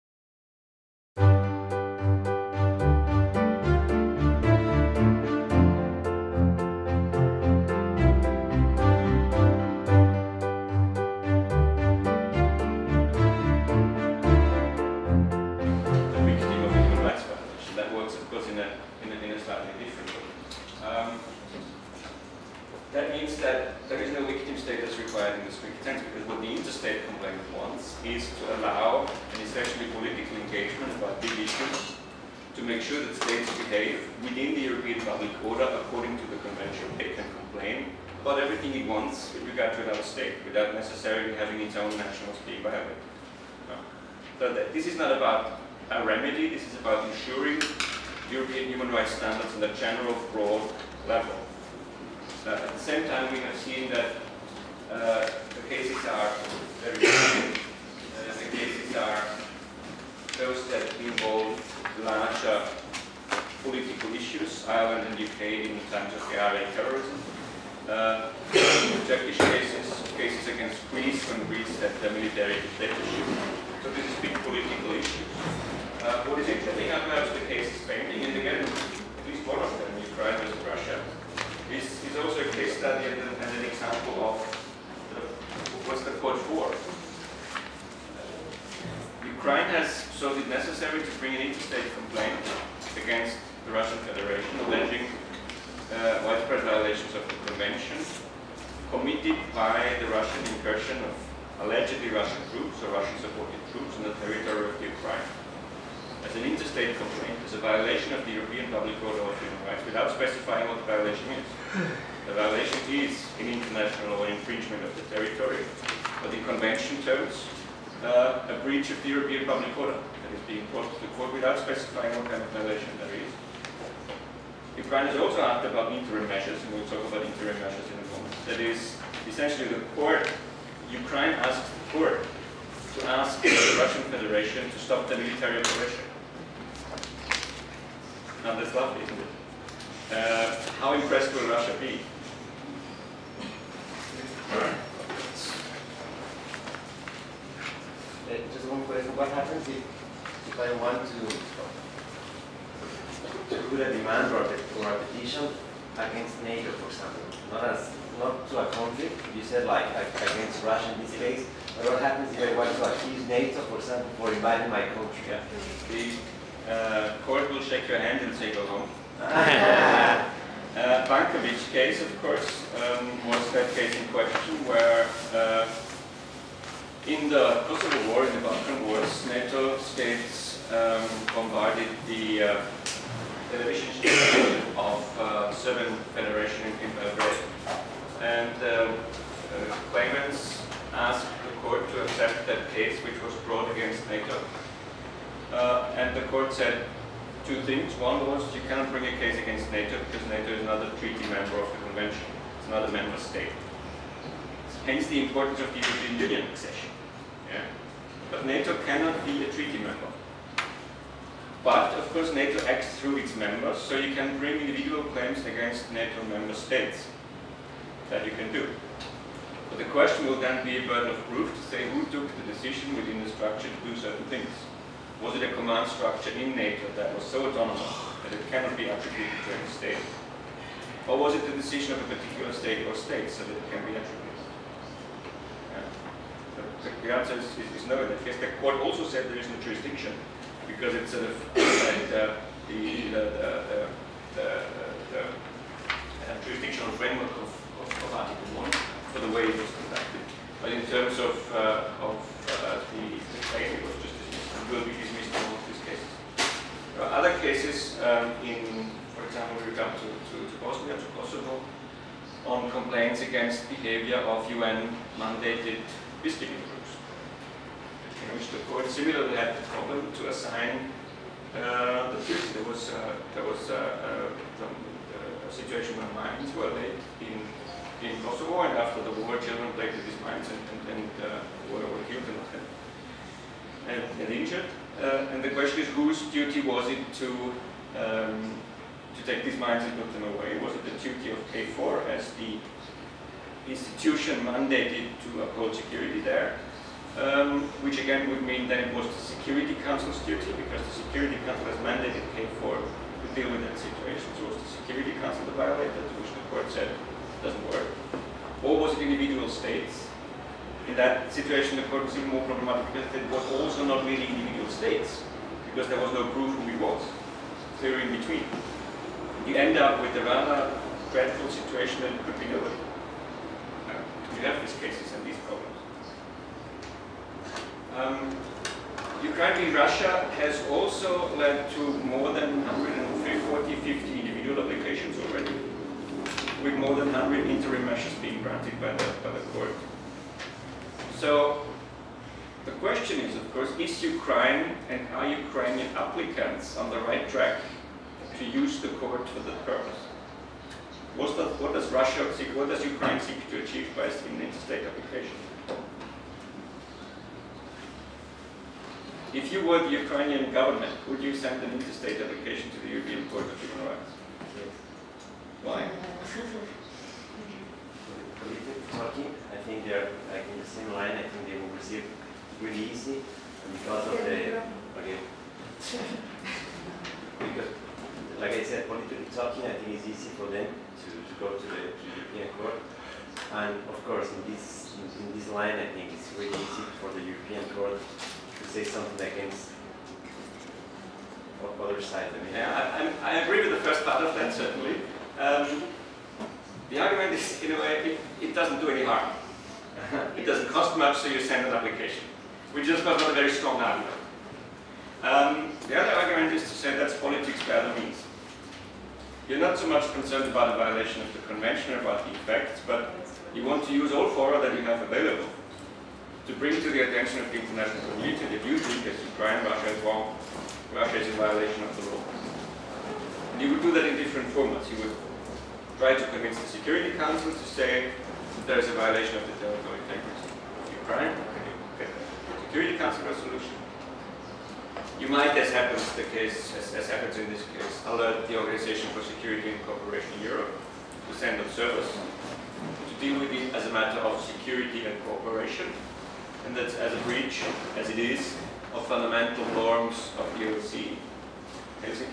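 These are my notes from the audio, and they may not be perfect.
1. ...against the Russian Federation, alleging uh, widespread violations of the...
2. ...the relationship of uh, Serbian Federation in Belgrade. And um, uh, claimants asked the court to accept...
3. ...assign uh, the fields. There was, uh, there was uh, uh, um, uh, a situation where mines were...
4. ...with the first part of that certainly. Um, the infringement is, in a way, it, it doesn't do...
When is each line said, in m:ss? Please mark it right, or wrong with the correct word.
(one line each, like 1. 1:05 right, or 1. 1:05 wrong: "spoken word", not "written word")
1. 1:33 right
2. 3:03 right
3. 4:30 right
4. 6:33 wrong: "argument", not "infringement".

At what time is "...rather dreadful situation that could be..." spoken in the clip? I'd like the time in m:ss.
5:20.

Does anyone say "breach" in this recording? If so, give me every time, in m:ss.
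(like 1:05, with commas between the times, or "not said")
1:58, 7:27.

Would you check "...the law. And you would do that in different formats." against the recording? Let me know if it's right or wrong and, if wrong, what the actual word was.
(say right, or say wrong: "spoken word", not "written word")
right.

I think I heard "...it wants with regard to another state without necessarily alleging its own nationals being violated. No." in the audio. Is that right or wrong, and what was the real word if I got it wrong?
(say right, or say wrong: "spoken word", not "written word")
wrong: "having", not "alleging".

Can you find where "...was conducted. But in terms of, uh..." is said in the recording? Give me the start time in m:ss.
4:09.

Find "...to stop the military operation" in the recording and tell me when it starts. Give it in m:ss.
2:14.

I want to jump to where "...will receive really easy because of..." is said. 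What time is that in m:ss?
6:11.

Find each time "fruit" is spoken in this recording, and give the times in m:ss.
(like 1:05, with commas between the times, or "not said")
not said.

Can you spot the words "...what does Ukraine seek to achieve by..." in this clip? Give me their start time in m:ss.
5:52.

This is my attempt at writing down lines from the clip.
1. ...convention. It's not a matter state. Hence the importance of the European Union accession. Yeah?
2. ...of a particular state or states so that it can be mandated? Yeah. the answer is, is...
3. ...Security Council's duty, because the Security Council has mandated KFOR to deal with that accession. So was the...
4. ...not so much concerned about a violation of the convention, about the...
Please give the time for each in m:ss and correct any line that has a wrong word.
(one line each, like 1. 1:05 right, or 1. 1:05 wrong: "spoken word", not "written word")
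1. 3:21 wrong: "member", not "matter"
2. 3:51 wrong: "attributed", not "mandated"
3. 4:59 wrong: "situation", not "accession"
4. 6:49 right.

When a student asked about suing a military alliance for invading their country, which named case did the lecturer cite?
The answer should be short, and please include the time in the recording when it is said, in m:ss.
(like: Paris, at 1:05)
Bankovic, at 2:51.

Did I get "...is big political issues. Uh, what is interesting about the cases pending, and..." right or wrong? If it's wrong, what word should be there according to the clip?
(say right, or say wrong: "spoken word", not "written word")
right.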